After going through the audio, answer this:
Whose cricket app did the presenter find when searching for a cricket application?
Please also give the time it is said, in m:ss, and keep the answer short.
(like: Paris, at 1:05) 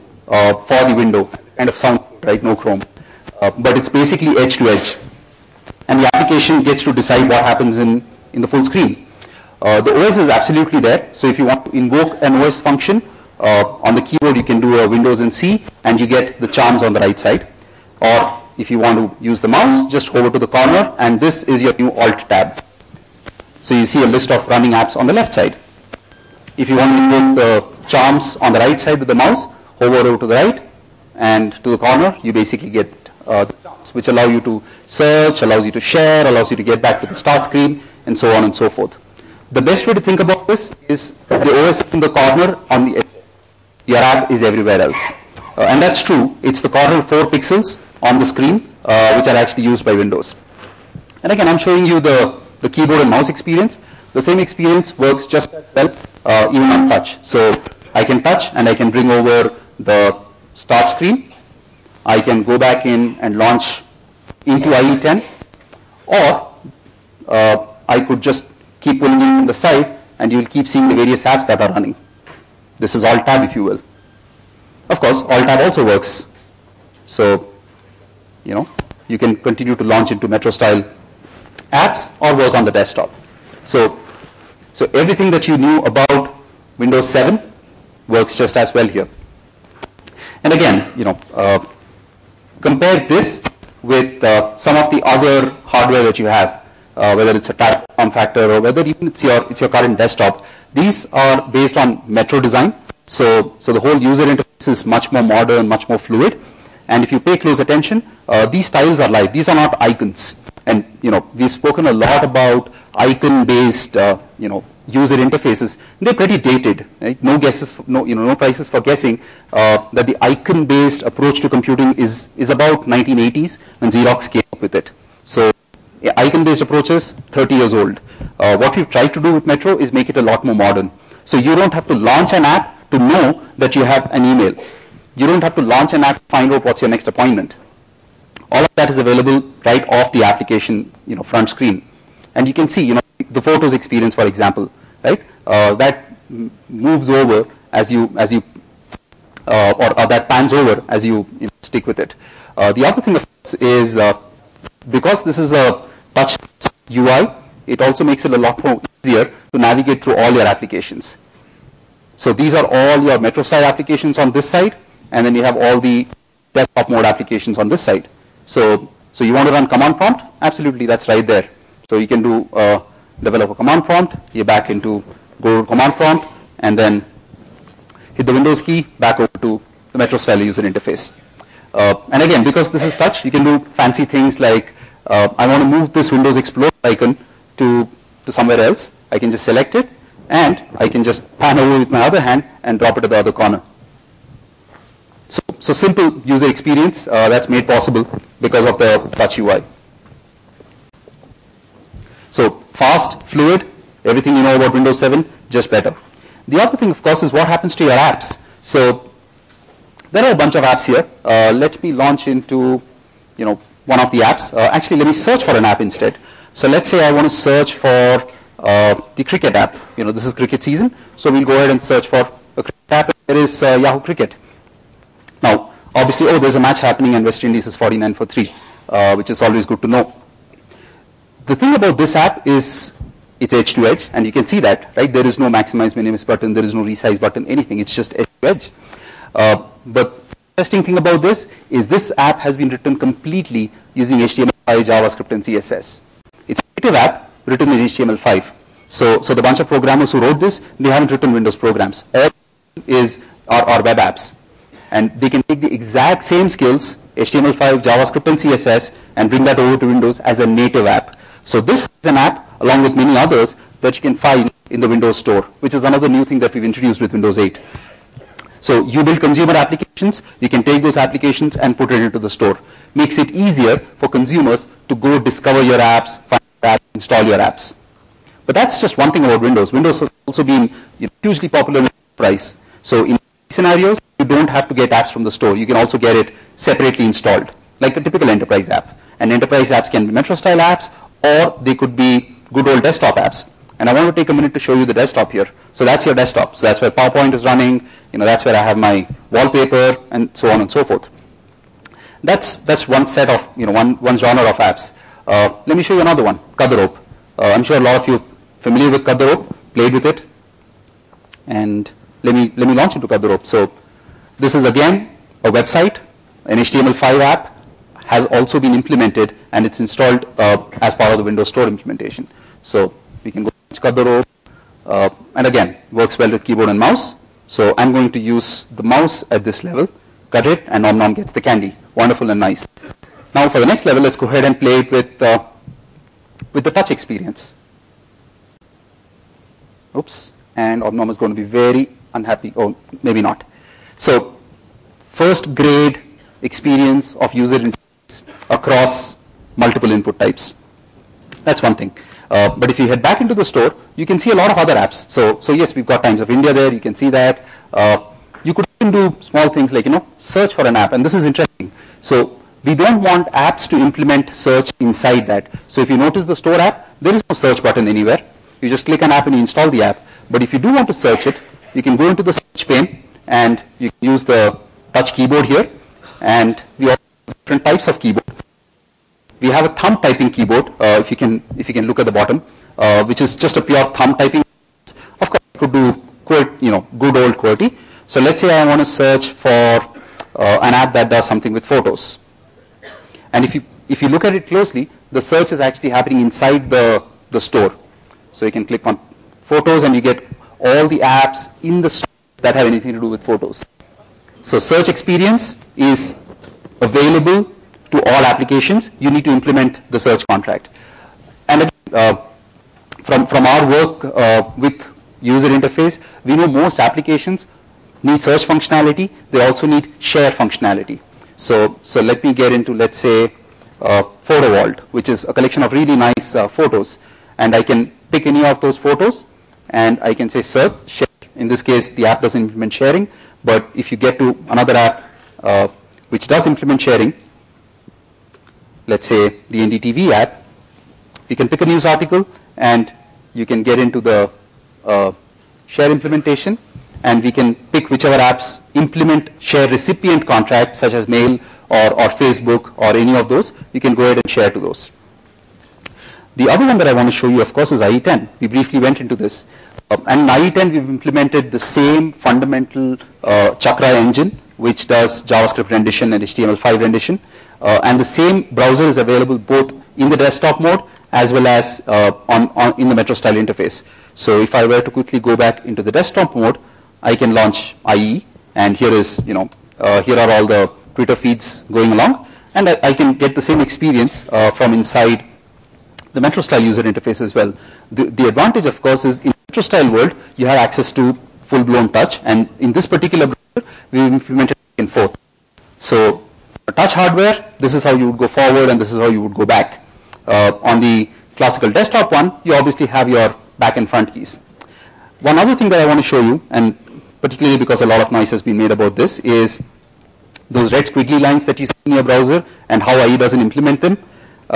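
Yahoo, at 3:43.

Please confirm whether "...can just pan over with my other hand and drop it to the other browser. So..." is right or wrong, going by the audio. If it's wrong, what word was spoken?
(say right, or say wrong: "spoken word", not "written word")
wrong: "corner", not "browser".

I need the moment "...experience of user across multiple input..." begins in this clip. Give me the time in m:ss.
5:46.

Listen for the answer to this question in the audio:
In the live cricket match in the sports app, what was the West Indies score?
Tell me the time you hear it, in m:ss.
3:47.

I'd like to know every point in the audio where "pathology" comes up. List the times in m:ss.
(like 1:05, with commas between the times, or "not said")
not said.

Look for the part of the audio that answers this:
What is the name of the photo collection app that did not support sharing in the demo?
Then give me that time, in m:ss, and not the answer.
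7:04.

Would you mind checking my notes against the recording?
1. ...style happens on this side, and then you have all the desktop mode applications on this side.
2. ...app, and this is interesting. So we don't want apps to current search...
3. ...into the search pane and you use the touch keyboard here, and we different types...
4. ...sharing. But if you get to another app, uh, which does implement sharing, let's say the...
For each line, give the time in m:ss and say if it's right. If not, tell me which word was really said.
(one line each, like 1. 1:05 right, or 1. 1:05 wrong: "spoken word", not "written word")
1. 2:43 wrong: "applications", not "happens"
2. 6:00 wrong: "implement", not "current"
3. 6:12 right
4. 7:12 right.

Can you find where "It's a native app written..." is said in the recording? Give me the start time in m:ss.
4:06.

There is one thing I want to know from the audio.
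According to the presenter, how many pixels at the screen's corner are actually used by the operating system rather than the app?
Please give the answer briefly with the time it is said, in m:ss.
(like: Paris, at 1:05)
4, at 0:47.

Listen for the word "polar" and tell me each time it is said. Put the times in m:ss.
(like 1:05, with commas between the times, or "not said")
not said.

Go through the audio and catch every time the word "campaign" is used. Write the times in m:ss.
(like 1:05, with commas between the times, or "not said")
not said.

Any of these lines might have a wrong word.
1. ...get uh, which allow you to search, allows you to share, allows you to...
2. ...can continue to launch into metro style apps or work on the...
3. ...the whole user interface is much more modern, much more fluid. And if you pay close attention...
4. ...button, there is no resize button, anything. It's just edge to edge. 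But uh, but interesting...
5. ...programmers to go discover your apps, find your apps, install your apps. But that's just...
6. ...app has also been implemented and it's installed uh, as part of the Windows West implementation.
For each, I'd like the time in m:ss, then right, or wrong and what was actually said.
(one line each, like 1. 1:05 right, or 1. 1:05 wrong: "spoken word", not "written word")
1. 0:32 right
2. 1:19 right
3. 1:43 right
4. 3:56 right
5. 4:34 wrong: "consumers", not "programmers"
6. 5:17 wrong: "Store", not "West".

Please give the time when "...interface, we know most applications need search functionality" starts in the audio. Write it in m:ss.
6:55.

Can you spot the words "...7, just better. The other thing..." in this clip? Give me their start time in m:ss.
3:24.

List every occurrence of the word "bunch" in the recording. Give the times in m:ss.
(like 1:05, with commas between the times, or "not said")
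3:30, 4:09.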